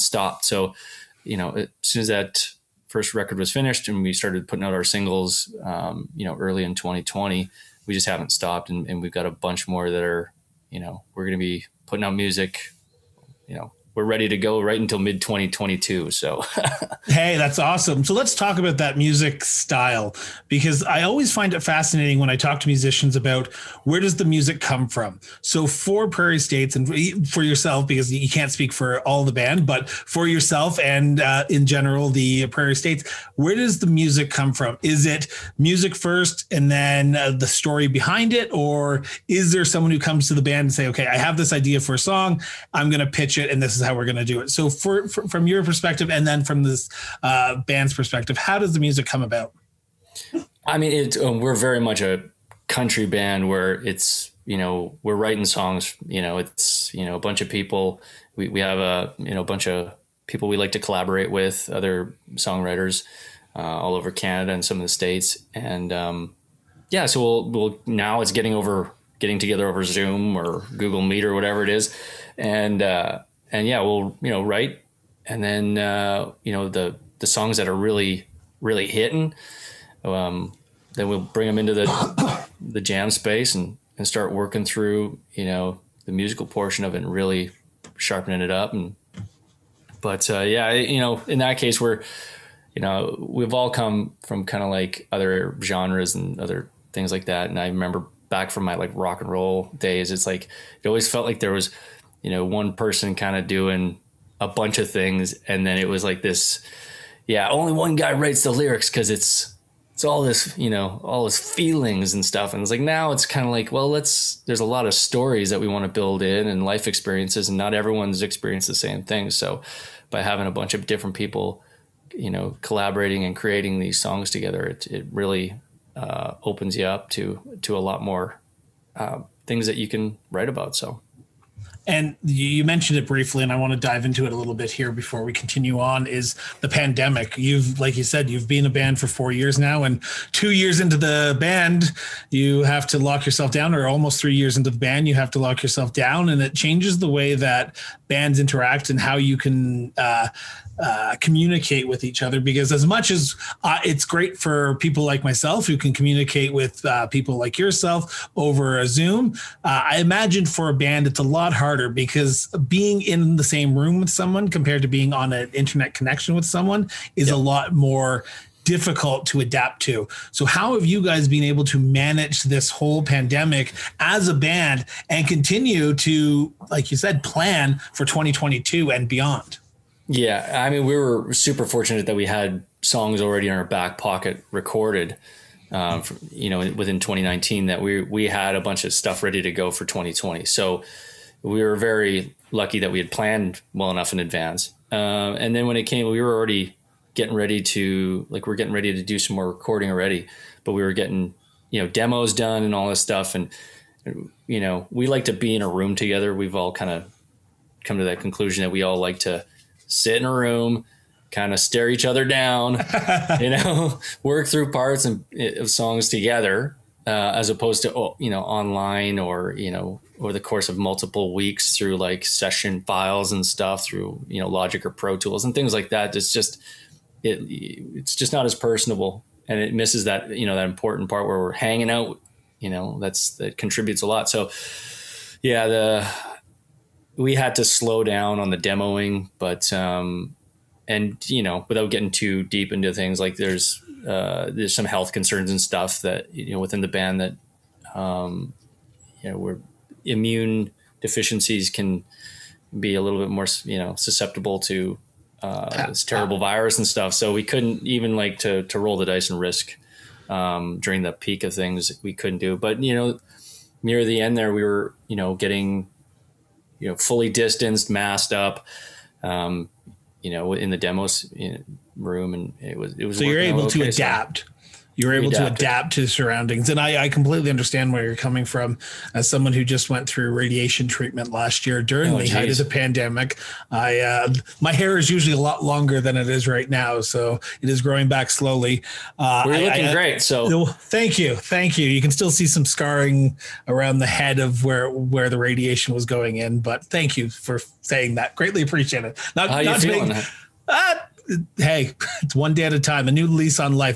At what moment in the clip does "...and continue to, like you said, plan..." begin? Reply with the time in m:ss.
2:55.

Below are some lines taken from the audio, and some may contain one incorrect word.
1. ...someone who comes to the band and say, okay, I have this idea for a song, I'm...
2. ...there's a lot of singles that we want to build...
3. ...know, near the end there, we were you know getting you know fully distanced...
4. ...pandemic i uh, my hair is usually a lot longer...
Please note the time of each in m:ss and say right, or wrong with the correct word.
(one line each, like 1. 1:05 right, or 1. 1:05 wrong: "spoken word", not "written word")
1. 0:39 right
2. 1:54 wrong: "stories", not "singles"
3. 4:22 right
4. 4:42 right.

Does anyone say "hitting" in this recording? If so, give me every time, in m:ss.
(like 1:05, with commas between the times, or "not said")
1:18.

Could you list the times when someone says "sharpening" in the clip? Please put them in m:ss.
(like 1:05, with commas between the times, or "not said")
1:27.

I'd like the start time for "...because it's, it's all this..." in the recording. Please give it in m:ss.
1:48.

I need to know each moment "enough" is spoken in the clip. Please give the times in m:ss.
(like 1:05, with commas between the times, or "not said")
3:13.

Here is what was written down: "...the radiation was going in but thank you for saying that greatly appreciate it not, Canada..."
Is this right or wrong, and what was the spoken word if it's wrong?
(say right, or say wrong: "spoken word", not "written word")
wrong: "How", not "Canada".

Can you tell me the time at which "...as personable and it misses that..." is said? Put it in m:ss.
3:48.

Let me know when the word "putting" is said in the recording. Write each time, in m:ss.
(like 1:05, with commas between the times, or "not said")
0:04, 0:11.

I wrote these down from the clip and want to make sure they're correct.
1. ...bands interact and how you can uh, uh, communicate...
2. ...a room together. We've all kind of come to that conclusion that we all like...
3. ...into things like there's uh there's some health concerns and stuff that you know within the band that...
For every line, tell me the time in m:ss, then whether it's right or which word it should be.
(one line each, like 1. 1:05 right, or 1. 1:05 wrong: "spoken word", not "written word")
1. 2:28 right
2. 3:25 right
3. 4:02 right.